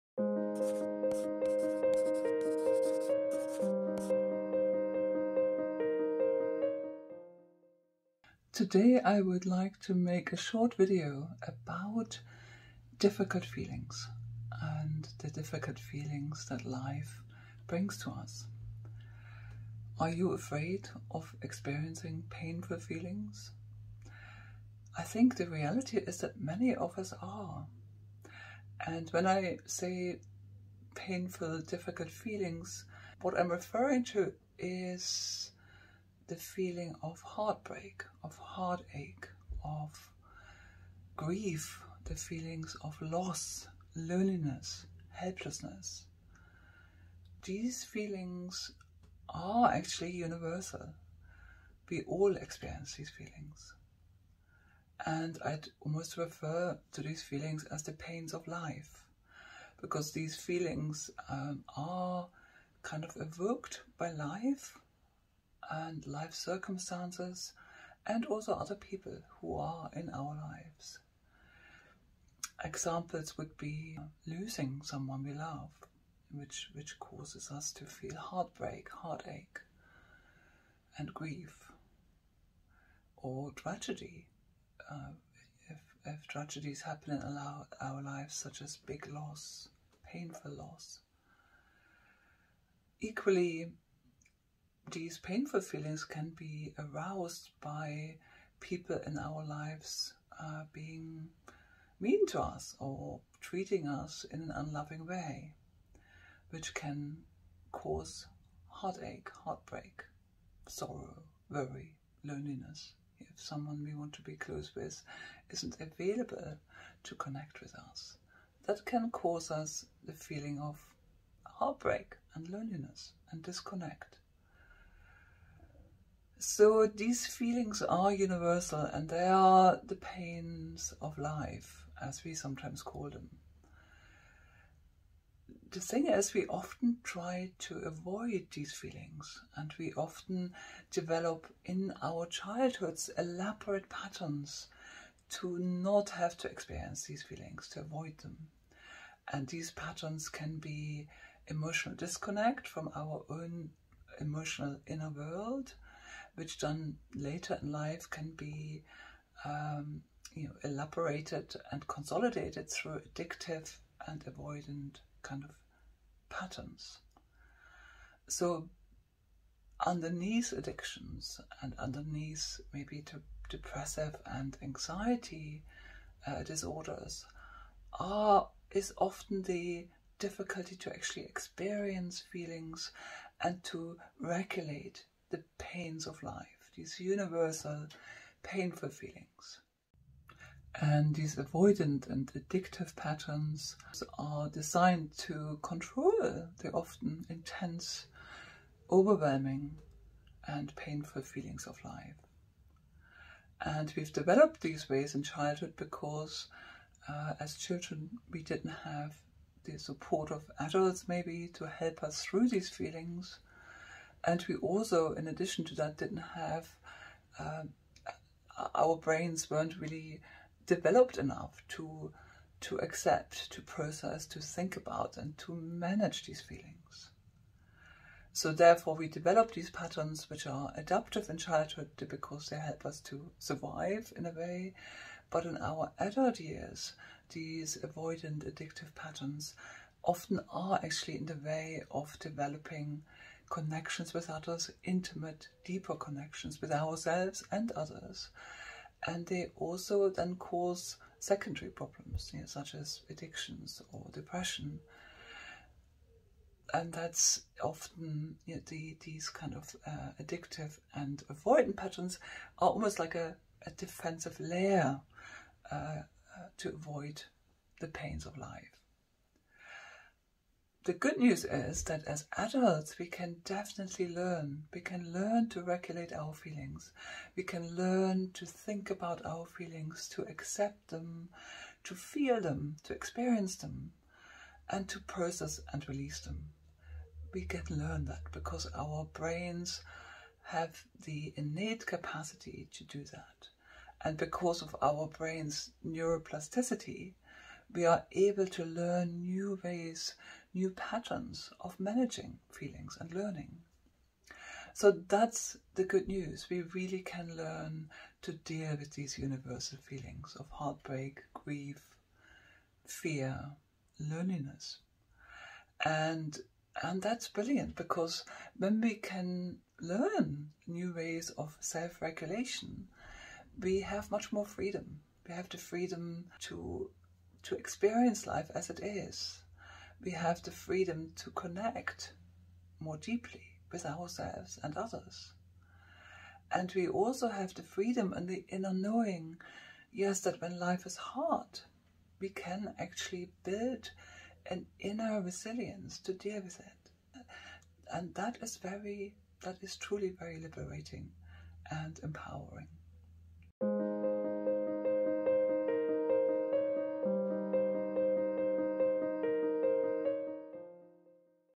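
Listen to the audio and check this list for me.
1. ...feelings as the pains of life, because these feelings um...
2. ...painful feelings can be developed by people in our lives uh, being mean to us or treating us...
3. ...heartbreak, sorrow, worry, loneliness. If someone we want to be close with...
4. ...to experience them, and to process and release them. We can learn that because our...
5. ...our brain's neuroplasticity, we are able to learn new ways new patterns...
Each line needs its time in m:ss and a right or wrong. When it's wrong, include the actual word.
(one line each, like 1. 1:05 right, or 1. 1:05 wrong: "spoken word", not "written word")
1. 0:57 right
2. 1:35 wrong: "aroused", not "developed"
3. 1:49 right
4. 4:42 right
5. 4:54 right.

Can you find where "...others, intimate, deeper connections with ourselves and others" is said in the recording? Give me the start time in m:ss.
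4:04.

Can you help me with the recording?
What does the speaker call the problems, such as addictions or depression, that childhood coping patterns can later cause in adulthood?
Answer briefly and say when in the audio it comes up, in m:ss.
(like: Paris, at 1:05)
secondary problems, at 4:11.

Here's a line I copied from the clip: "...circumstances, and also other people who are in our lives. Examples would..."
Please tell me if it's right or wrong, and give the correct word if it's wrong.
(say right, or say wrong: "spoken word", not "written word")
right.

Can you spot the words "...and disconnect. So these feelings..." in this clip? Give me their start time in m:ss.
2:03.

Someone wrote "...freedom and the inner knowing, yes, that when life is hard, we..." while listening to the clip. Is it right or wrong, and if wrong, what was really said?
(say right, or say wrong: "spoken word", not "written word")
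right.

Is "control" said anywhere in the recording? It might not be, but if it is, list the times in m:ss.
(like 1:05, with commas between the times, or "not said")
3:15.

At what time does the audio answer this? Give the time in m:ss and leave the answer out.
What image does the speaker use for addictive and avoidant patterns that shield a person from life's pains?
4:23.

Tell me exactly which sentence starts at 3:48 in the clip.
So therefore, we develop these patterns which are adaptive in childhood because they help us to survive in a way.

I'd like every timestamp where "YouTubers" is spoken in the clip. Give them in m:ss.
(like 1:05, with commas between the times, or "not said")
not said.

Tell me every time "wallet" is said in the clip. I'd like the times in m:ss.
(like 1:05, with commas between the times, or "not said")
not said.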